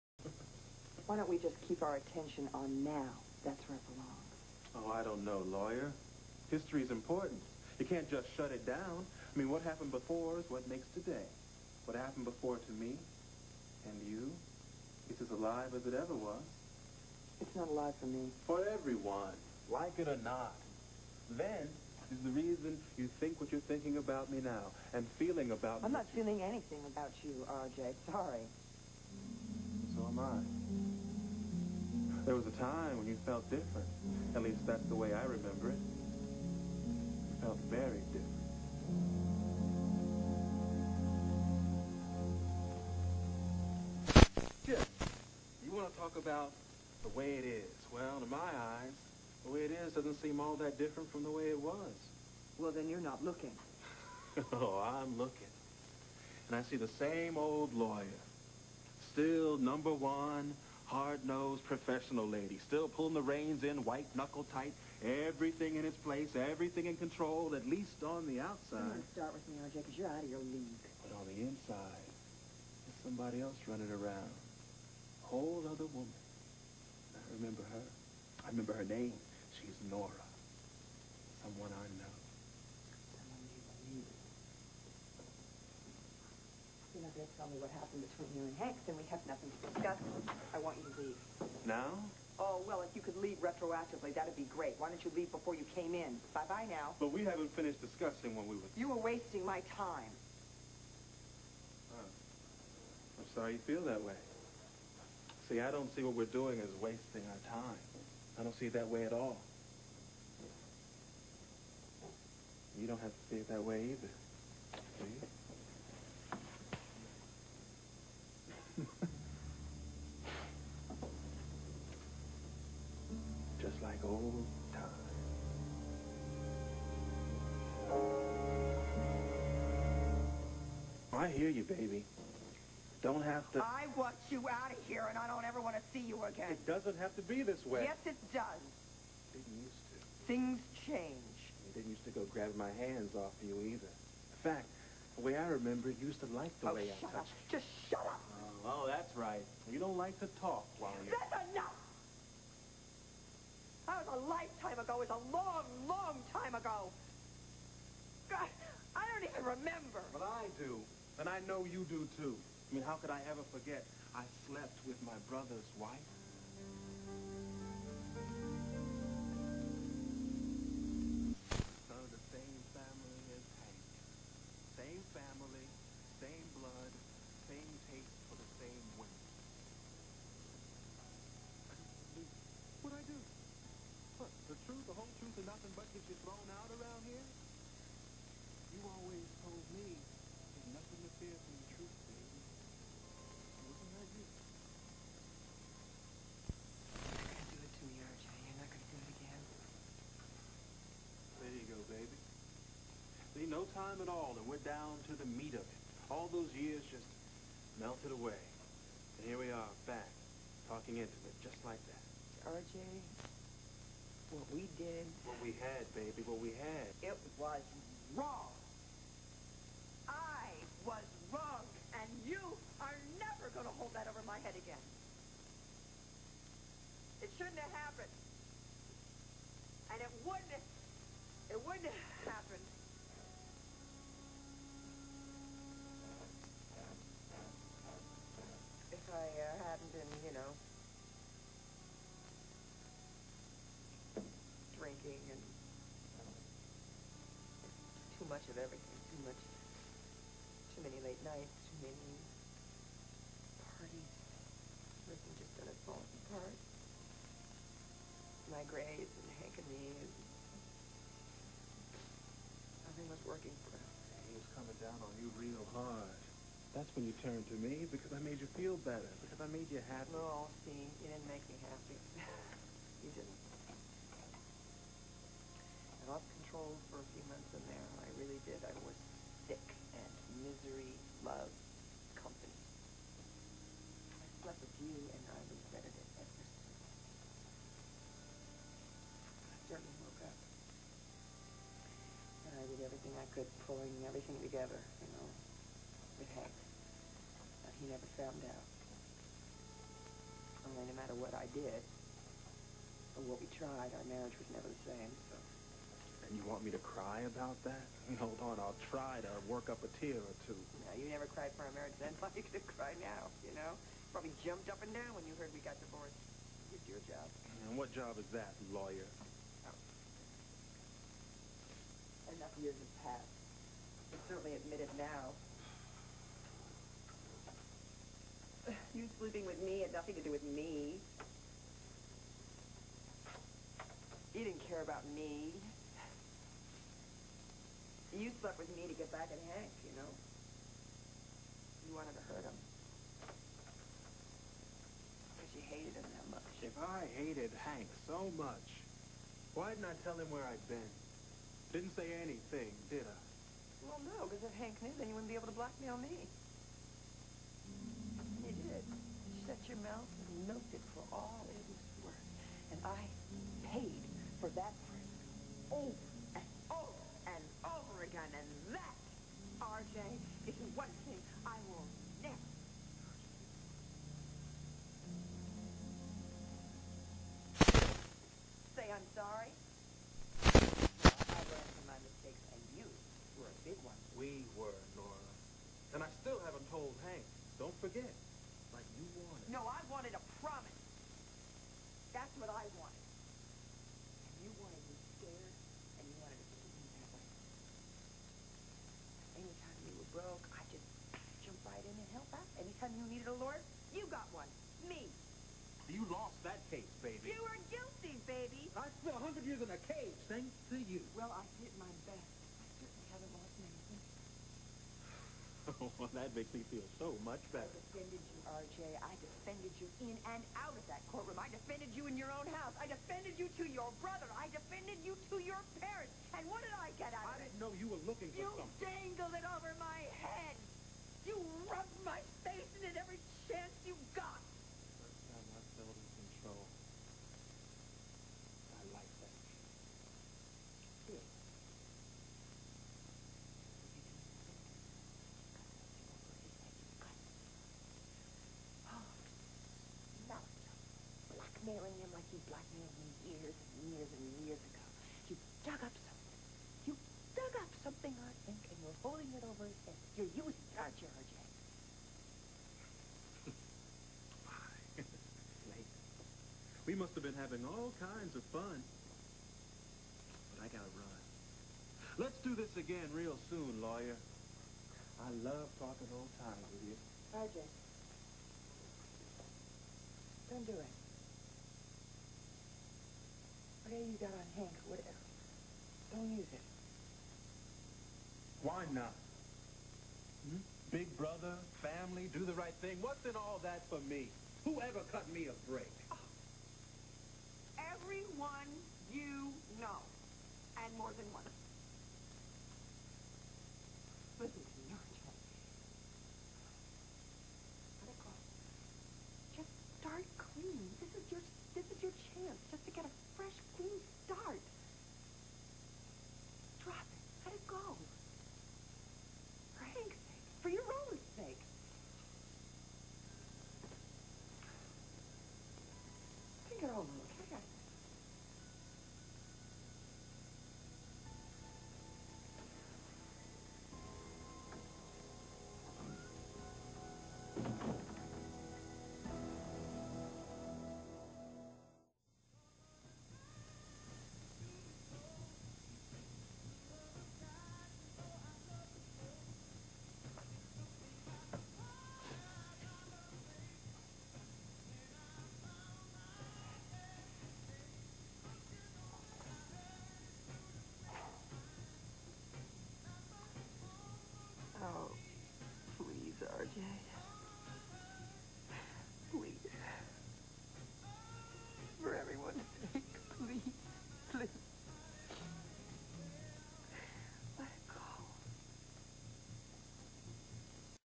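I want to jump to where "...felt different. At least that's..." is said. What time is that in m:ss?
0:33.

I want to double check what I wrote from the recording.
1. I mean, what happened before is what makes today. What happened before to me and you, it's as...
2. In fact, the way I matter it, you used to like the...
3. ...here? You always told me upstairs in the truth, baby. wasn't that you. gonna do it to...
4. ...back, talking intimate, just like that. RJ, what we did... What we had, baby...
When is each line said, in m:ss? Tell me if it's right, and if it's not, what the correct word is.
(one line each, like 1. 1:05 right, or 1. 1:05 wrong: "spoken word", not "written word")
1. 0:09 right
2. 2:23 wrong: "remember", not "matter"
3. 3:07 right
4. 3:29 right.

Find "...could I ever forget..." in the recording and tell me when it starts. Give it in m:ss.
2:42.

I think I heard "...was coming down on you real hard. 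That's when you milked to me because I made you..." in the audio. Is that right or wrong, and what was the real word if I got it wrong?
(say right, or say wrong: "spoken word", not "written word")
wrong: "turned", not "milked".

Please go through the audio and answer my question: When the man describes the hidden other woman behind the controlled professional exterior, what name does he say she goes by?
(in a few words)
Nora.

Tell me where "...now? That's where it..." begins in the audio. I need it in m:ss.
0:02.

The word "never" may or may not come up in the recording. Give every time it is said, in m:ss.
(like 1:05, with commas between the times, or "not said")
4:57, 5:04, 5:11, 6:12.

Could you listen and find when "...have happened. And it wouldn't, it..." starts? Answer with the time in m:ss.
3:47.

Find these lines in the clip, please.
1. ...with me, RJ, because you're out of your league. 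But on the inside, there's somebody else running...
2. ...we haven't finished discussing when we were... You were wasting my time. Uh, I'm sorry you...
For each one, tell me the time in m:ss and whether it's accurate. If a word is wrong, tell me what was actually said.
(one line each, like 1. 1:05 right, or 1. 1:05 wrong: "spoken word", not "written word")
1. 1:09 right
2. 1:37 right.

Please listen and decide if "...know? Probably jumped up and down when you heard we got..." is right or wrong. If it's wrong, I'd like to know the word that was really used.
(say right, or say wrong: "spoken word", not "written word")
right.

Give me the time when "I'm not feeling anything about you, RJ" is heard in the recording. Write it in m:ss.
0:25.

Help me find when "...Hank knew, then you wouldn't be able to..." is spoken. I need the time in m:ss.
5:54.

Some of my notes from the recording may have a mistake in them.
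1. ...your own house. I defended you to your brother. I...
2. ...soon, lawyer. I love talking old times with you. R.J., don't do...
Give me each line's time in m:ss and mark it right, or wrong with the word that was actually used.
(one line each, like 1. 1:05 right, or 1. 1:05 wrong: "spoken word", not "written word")
1. 7:02 right
2. 7:53 right.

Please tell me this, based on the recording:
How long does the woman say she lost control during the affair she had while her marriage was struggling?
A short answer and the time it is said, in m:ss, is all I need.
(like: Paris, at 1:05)
A few months, at 4:37.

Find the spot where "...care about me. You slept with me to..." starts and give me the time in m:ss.
5:34.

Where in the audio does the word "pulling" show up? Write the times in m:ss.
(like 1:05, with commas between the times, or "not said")
1:02, 4:53.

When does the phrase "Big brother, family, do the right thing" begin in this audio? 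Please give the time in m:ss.
8:10.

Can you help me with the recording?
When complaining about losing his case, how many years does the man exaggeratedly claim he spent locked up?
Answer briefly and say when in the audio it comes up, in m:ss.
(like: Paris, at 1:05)
100, at 6:49.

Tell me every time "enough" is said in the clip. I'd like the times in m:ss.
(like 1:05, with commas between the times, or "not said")
2:31, 5:22.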